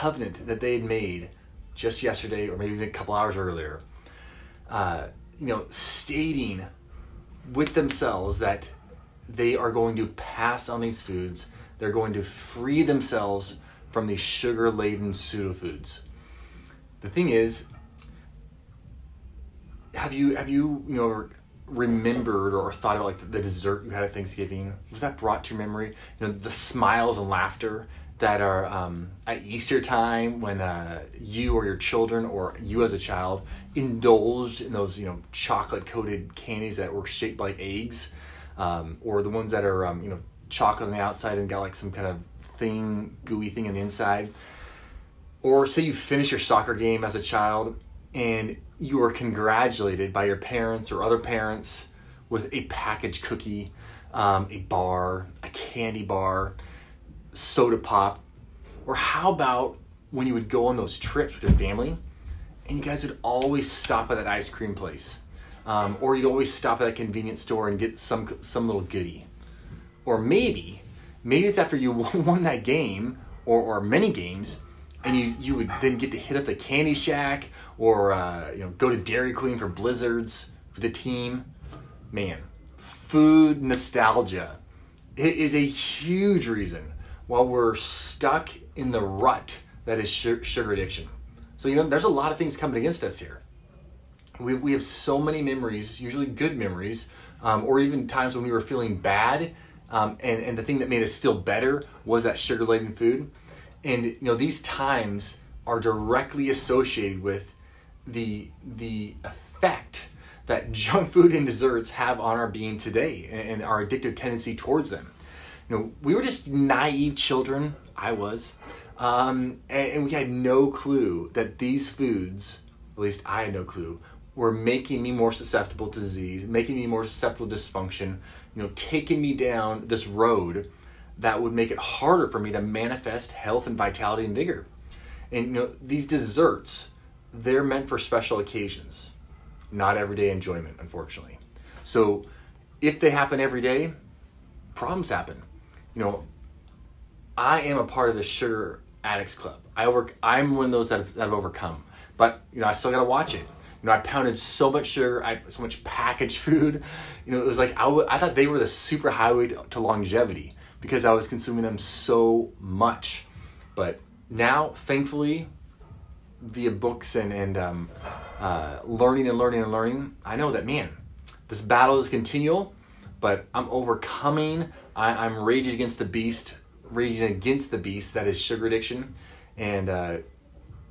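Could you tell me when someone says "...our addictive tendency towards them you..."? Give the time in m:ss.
1:53.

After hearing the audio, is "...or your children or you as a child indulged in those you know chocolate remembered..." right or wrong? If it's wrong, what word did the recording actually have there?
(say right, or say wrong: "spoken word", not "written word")
wrong: "coated", not "remembered".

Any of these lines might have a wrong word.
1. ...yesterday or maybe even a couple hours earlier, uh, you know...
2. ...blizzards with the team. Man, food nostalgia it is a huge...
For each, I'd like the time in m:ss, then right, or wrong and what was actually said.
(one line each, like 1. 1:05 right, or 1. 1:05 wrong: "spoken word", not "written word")
1. 0:02 right
2. 1:19 right.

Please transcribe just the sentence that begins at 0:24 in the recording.
Was that brought to your memory?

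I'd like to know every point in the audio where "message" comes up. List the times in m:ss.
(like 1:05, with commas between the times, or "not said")
not said.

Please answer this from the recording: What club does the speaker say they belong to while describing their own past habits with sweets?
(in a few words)
The sugar addicts club.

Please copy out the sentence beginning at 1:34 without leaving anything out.
We, we have so many memories, usually good memories, um, or even times when we were feeling bad.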